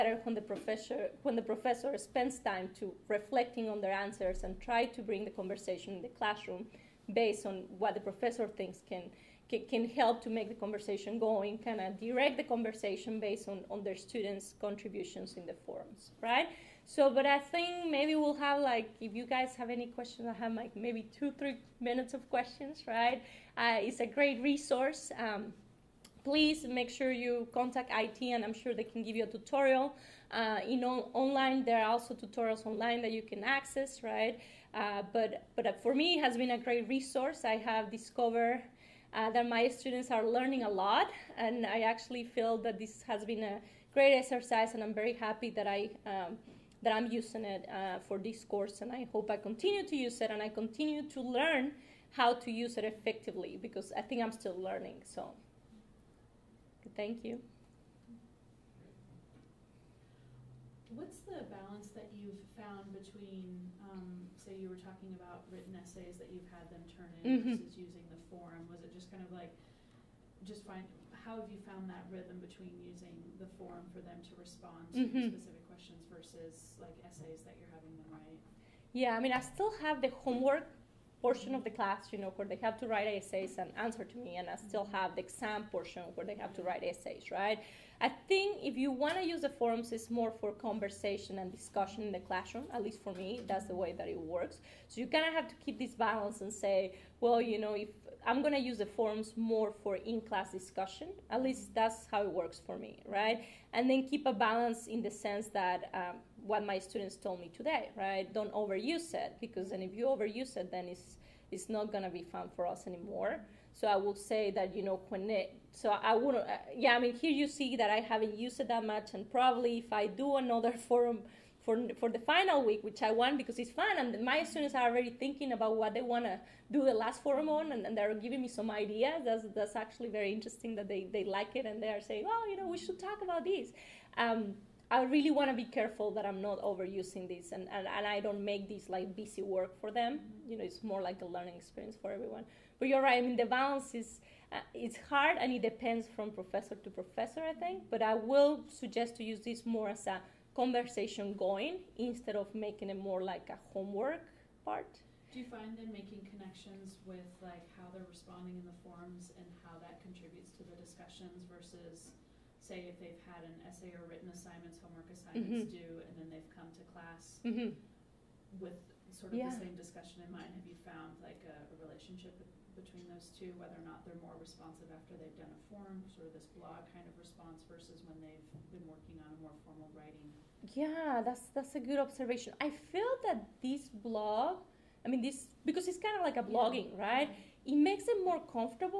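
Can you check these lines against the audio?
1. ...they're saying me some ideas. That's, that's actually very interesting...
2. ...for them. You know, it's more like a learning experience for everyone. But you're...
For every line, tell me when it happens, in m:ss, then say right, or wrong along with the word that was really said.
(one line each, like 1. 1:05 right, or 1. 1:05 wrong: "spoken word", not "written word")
1. 2:07 wrong: "giving", not "saying"
2. 2:19 right.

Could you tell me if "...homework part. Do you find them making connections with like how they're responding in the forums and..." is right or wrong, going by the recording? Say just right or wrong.
right.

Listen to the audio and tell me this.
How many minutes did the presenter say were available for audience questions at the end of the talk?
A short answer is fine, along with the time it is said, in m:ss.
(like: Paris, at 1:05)
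two, three minutes, at 0:21.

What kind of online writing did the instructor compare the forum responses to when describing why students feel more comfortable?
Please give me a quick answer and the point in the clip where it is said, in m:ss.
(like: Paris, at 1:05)
blogging, at 3:06.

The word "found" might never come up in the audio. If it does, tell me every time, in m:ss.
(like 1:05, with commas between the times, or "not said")
1:02, 1:11, 2:50.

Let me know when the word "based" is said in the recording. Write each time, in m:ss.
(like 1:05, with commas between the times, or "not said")
0:07, 0:13.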